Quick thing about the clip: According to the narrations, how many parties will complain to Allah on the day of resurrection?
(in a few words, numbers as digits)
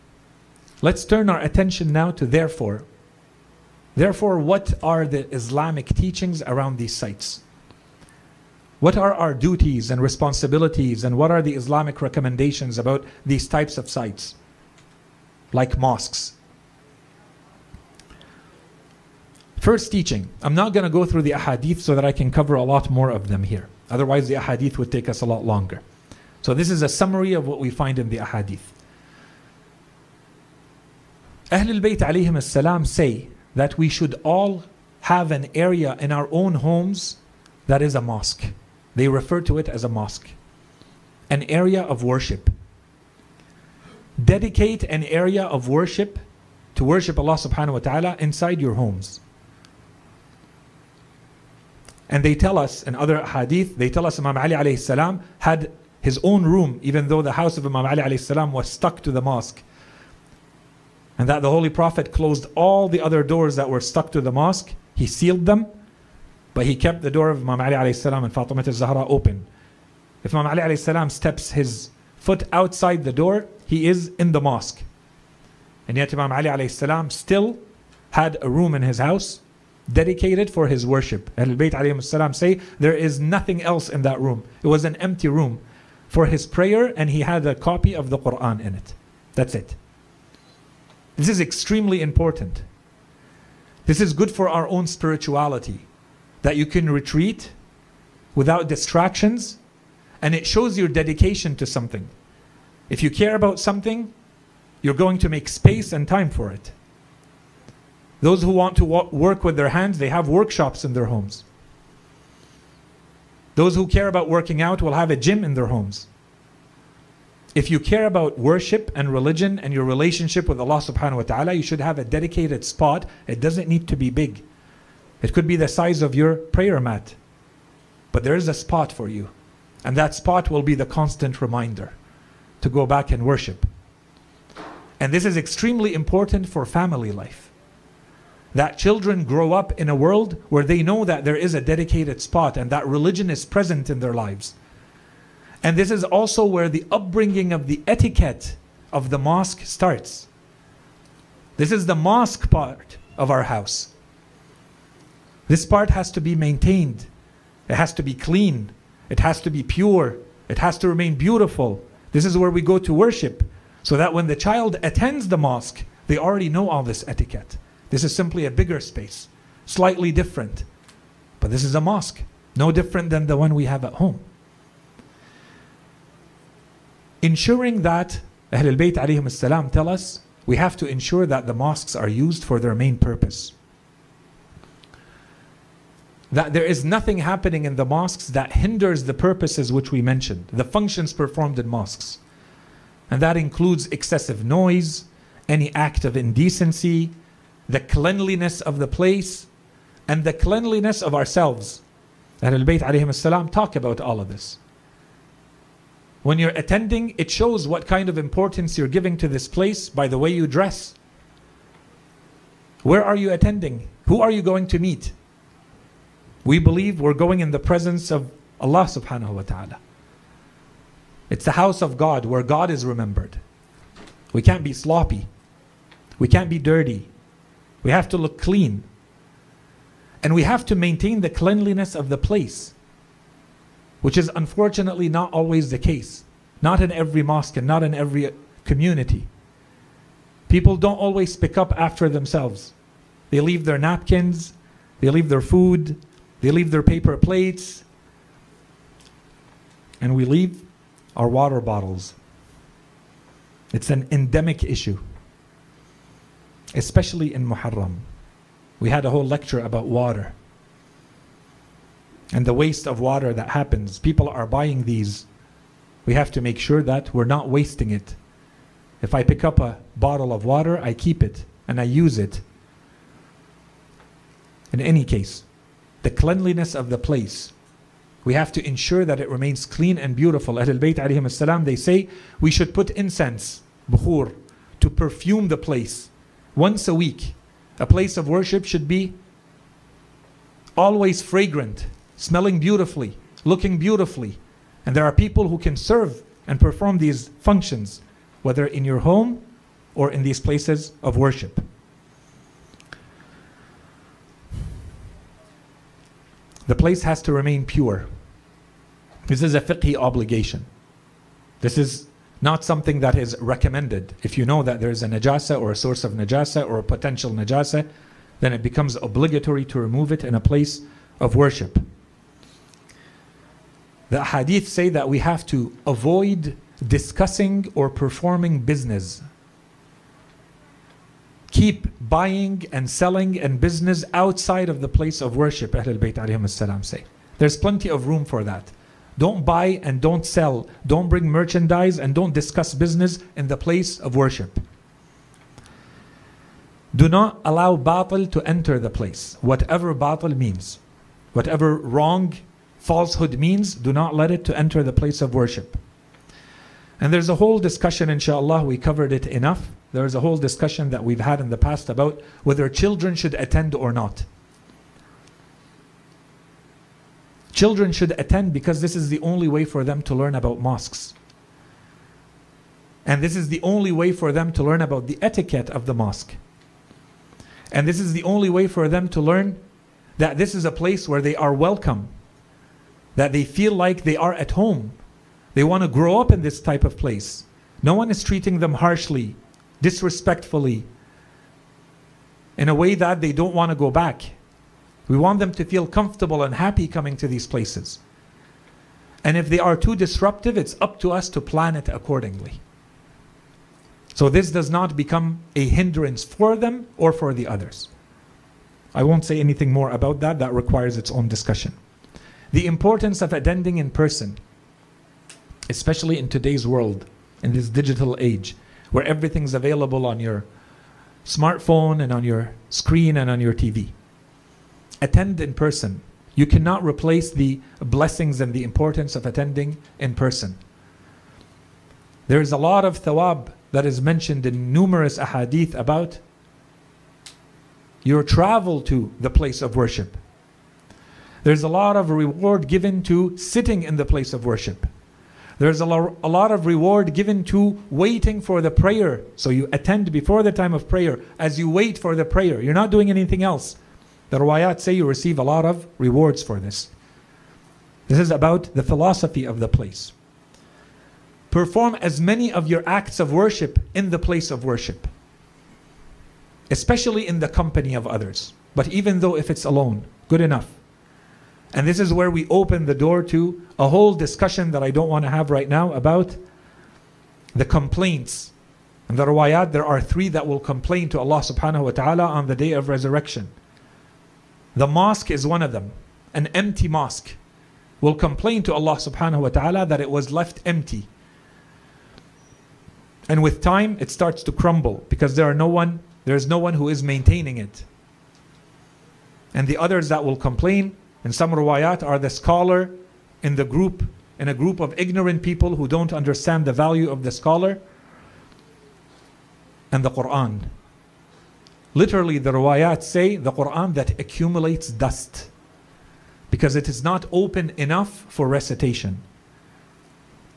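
3.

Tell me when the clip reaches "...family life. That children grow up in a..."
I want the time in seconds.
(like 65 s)
136 s.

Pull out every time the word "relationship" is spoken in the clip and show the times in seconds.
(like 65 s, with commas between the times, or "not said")
119 s.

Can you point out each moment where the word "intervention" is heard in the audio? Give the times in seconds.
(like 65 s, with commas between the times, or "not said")
not said.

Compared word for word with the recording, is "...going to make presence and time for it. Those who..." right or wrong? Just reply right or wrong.
wrong.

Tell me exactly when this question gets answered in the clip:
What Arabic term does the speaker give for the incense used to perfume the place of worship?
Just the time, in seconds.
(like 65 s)
283 s.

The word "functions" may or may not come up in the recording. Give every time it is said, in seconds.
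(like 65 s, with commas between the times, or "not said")
190 s, 297 s.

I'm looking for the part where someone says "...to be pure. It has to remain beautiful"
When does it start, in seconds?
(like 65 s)
159 s.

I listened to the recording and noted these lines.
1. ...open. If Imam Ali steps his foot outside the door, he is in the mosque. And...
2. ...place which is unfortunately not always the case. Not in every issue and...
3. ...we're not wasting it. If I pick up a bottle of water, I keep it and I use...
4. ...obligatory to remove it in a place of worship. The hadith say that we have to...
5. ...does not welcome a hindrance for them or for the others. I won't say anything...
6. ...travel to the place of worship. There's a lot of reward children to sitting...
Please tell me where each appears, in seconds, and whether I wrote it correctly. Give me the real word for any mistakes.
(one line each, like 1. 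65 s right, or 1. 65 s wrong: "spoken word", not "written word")
1. 69 s right
2. 232 s wrong: "mosque", not "issue"
3. 267 s right
4. 318 s right
5. 404 s wrong: "become", not "welcome"
6. 438 s wrong: "given", not "children".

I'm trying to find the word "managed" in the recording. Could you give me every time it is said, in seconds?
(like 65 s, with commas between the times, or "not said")
not said.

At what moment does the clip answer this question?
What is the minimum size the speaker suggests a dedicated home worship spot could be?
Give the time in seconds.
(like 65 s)
125 s.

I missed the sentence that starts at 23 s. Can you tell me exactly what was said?
Otherwise, the ahadith would take us a lot longer.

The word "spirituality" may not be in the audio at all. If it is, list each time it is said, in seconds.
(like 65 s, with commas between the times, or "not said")
94 s.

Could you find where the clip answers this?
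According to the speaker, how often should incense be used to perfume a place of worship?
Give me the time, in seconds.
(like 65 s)
286 s.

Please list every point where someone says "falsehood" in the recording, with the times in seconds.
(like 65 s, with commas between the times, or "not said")
352 s.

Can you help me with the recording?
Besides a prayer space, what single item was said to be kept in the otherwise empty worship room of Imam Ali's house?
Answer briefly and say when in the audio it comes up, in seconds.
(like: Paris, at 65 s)
a copy of the Quran, at 87 s.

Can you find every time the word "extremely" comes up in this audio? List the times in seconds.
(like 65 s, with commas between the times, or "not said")
91 s, 135 s.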